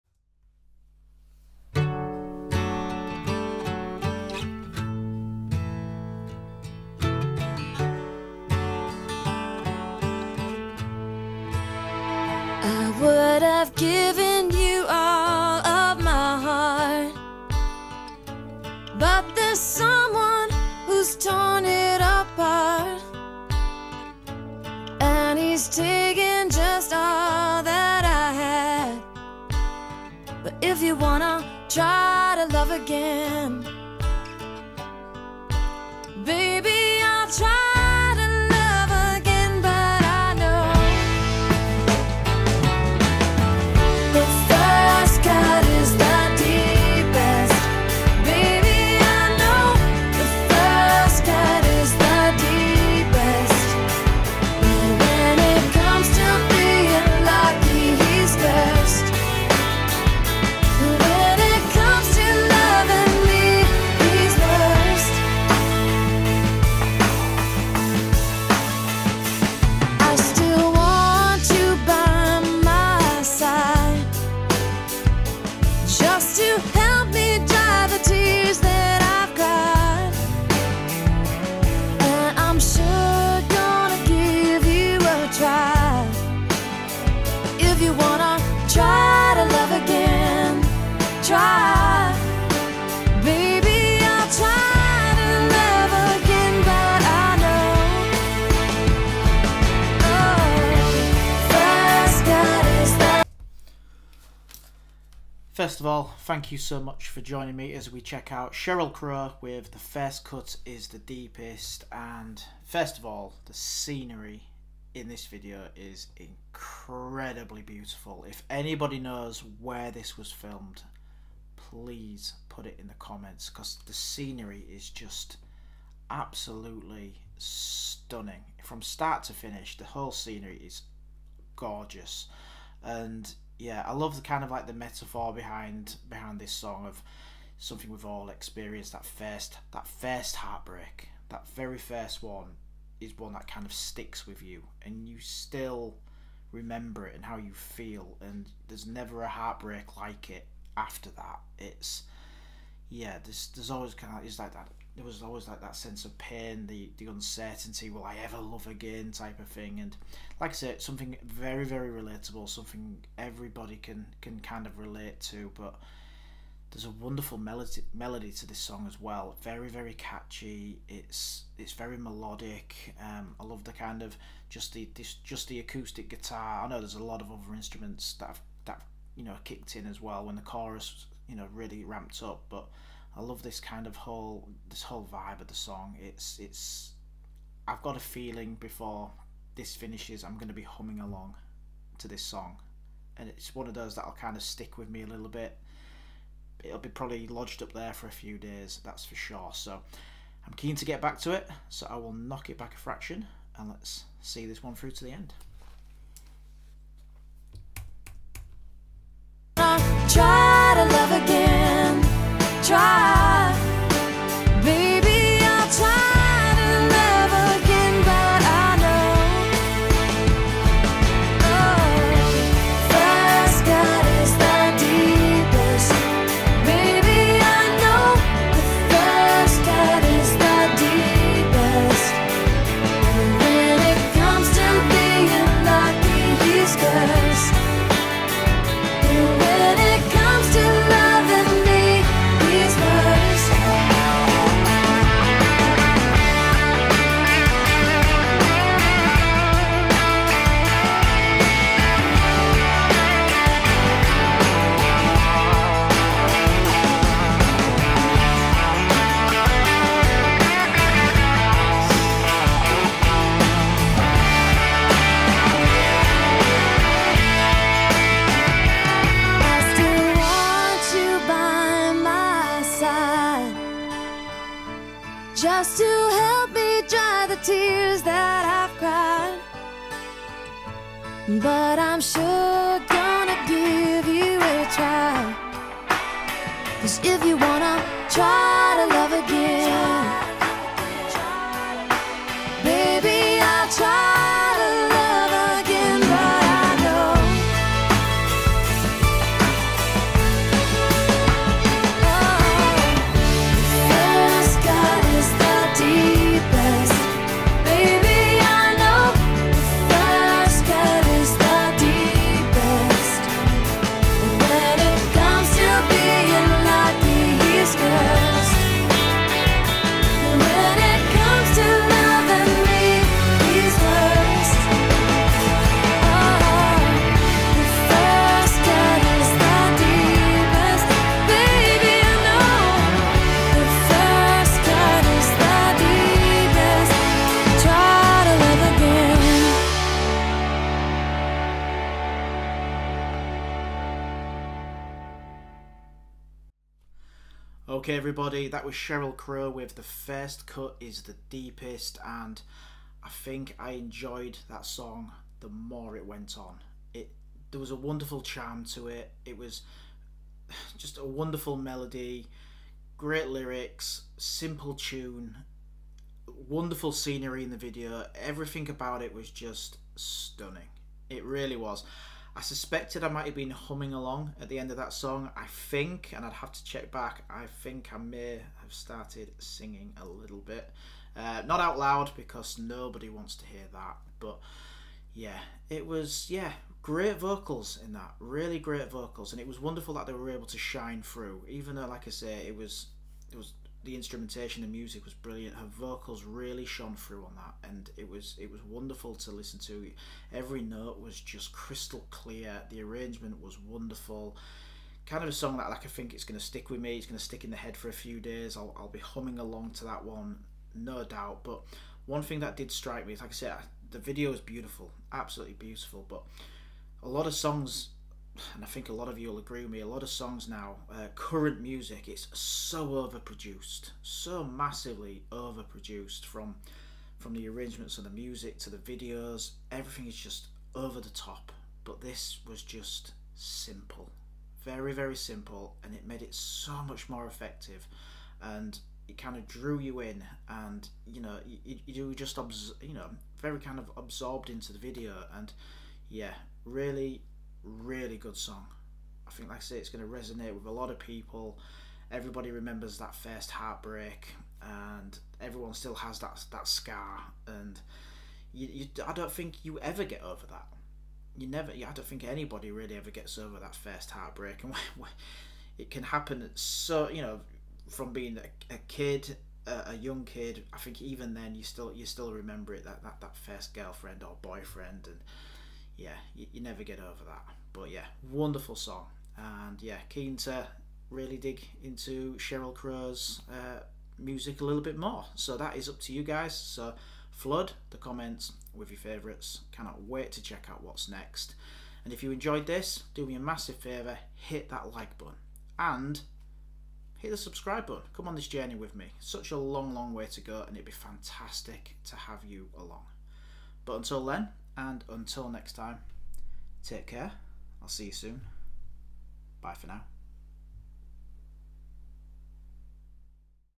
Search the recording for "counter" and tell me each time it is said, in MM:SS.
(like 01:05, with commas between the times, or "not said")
not said.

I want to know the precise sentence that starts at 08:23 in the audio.
But until then, and until next time, take care.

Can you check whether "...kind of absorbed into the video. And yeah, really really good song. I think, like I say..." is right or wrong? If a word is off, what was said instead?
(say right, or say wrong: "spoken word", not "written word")
right.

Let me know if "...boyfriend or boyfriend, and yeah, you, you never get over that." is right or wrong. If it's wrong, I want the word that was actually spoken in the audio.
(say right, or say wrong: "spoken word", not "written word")
wrong: "girlfriend", not "boyfriend".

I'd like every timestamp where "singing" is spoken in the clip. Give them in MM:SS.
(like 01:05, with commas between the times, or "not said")
06:19.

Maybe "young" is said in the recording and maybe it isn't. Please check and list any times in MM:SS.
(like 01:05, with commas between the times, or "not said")
07:49.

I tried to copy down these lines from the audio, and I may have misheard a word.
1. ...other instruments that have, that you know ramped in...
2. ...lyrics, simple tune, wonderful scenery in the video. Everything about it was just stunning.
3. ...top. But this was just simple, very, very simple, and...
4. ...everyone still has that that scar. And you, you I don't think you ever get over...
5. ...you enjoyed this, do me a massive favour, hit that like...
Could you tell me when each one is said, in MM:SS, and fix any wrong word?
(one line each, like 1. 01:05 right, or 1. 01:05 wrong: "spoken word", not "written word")
1. 02:57 wrong: "kicked", not "ramped"
2. 06:03 right
3. 07:11 right
4. 07:35 right
5. 08:12 right.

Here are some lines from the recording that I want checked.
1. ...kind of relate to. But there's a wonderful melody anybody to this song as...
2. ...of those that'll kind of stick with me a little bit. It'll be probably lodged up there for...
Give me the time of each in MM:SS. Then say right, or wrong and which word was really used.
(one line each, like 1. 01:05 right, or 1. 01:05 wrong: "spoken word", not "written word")
1. 02:44 wrong: "melody", not "anybody"
2. 03:13 right.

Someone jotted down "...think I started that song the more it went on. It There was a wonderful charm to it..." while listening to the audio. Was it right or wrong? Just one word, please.
wrong.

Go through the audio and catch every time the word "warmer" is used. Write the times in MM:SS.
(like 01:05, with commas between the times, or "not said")
not said.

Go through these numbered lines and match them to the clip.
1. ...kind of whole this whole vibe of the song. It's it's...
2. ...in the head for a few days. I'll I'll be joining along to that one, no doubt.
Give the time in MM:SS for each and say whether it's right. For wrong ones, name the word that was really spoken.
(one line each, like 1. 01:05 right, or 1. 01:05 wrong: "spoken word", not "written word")
1. 03:03 right
2. 06:47 wrong: "humming", not "joining".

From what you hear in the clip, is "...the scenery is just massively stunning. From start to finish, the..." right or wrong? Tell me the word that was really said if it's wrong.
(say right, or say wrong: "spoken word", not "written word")
wrong: "absolutely", not "massively".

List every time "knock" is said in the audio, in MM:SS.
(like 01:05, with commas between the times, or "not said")
03:22.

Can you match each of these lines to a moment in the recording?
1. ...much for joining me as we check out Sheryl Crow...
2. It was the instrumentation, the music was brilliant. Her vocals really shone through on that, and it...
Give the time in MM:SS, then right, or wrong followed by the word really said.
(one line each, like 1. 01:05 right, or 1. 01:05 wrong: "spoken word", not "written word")
1. 01:46 right
2. 06:33 right.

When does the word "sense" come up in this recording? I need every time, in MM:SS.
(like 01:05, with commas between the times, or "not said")
02:35.